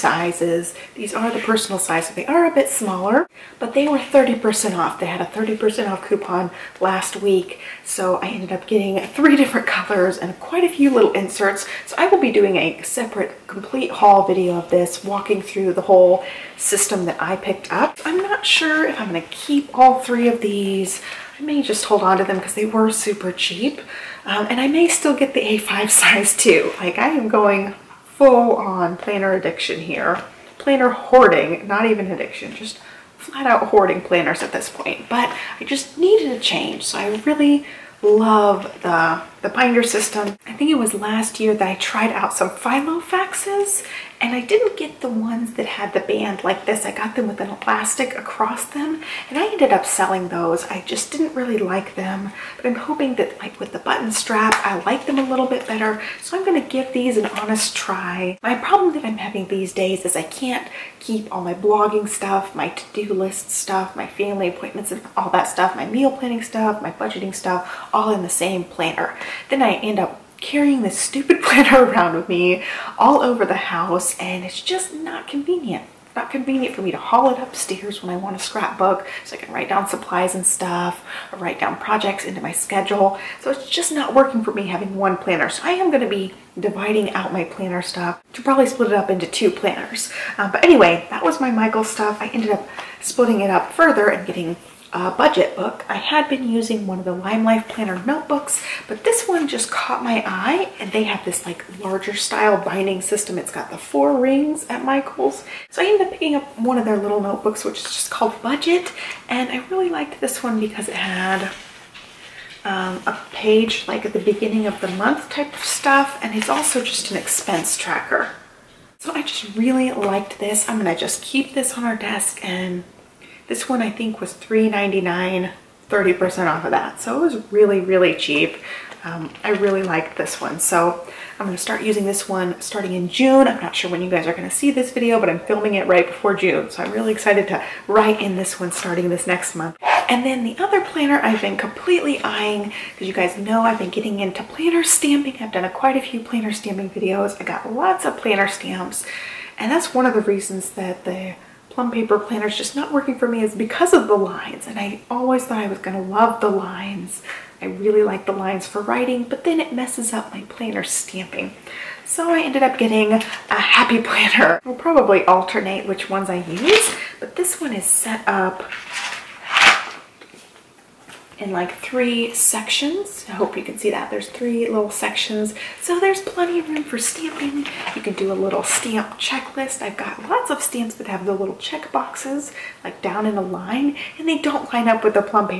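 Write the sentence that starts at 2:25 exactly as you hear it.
I've done a, quite a few planner stamping videos.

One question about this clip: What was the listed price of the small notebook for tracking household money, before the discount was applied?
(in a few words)
$3.99.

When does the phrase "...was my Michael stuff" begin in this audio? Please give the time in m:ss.
1:31.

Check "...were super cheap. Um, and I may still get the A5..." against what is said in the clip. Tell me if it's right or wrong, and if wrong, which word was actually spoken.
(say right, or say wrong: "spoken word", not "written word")
right.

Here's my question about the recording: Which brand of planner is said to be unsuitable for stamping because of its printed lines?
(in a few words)
Plum Paper.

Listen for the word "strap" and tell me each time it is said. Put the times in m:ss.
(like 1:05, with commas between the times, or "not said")
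0:54.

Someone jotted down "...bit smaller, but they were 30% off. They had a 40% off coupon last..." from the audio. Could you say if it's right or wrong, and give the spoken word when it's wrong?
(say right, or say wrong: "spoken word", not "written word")
wrong: "30", not "40".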